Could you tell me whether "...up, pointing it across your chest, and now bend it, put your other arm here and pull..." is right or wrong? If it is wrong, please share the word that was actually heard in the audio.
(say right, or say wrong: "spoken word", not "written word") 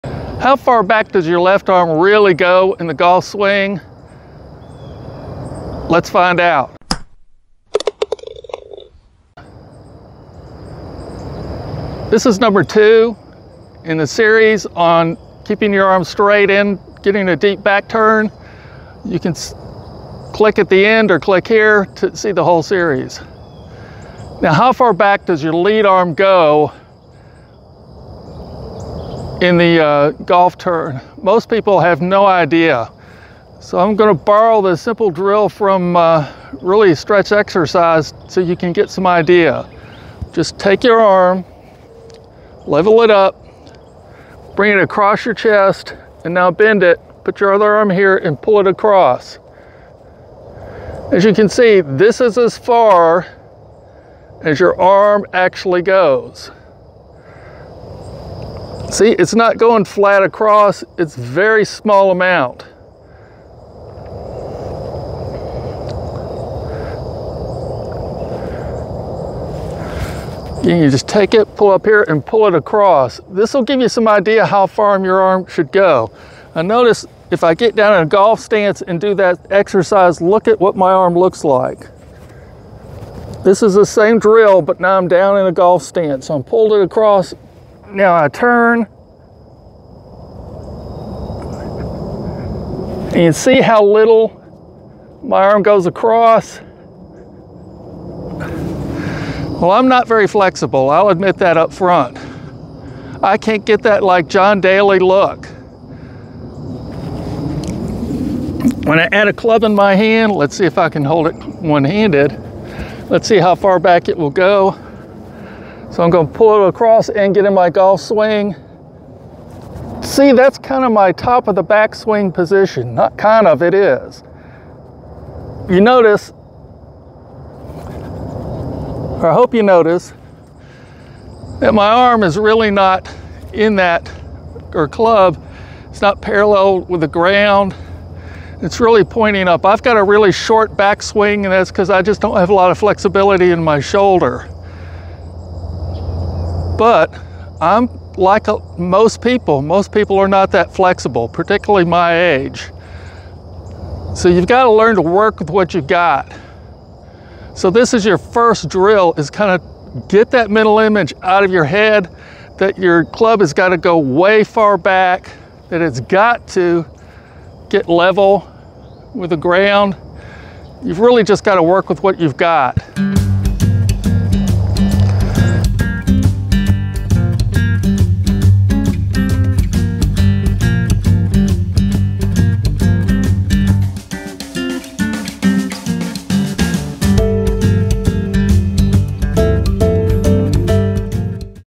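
wrong: "bring", not "pointing".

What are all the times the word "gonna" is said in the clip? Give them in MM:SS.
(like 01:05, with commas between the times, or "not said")
00:33, 01:56.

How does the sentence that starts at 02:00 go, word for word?
See, that's kind of my top of the backswing position.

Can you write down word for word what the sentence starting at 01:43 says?
I can't get that like John Daly look.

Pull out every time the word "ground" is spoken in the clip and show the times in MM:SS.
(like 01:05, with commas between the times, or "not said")
02:17, 02:49.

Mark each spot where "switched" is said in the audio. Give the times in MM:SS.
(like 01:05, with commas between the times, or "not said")
not said.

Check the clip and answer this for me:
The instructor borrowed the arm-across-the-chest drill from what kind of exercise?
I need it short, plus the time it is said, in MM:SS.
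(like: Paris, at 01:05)
stretch exercise, at 00:36.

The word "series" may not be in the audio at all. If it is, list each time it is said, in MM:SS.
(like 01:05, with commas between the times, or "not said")
00:14, 00:22.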